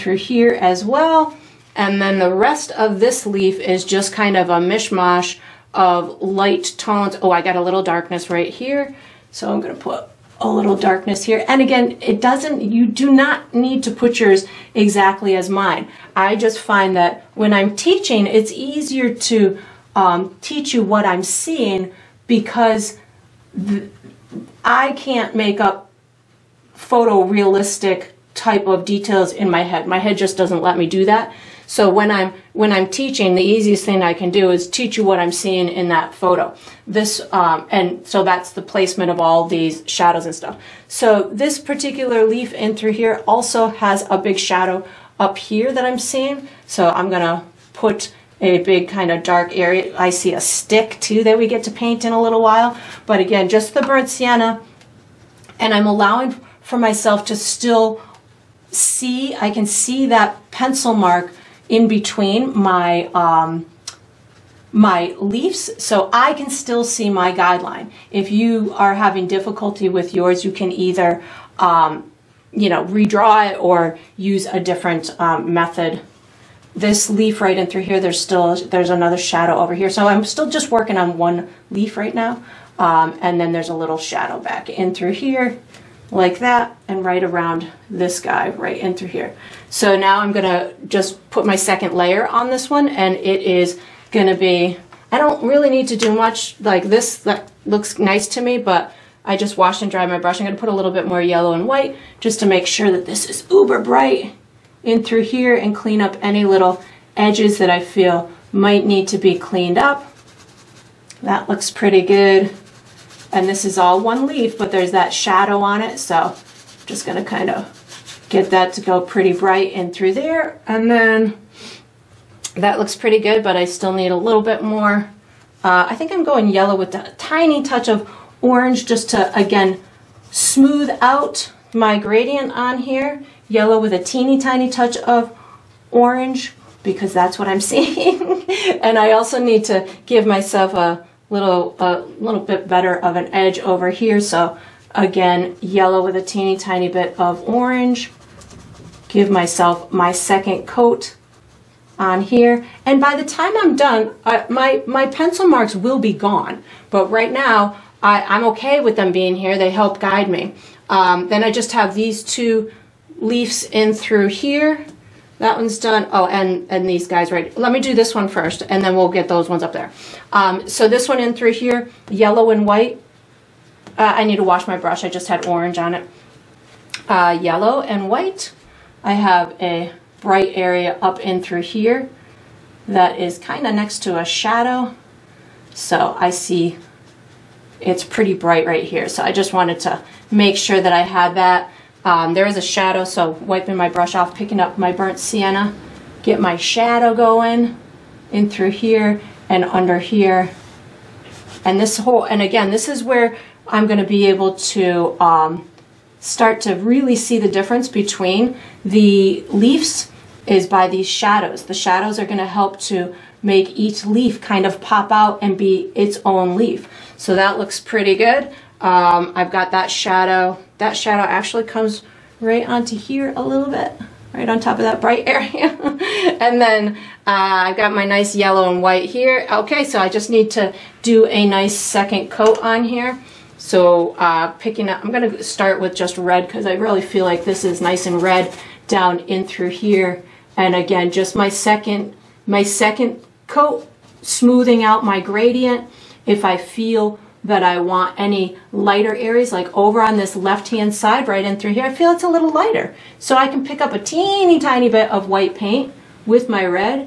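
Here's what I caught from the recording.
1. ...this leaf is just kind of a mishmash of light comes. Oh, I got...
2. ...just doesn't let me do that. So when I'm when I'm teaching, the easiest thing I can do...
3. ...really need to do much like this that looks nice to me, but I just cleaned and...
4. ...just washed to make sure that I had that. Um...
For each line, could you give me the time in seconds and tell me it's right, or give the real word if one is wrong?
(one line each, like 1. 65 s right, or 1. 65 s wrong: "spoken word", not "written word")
1. 2 s wrong: "tones", not "comes"
2. 30 s right
3. 95 s wrong: "washed", not "cleaned"
4. 189 s wrong: "wanted", not "washed".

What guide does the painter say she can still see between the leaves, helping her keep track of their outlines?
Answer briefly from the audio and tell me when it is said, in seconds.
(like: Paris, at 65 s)
pencil mark, at 60 s.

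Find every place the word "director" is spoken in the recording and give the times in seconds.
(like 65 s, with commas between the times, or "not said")
not said.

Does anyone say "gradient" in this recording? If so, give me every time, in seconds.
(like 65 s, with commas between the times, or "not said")
131 s, 245 s.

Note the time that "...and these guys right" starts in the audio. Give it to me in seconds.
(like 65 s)
166 s.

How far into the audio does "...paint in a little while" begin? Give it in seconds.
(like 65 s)
51 s.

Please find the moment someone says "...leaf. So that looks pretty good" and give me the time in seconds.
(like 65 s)
216 s.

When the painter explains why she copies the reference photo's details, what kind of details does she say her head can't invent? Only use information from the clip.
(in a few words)
photorealistic.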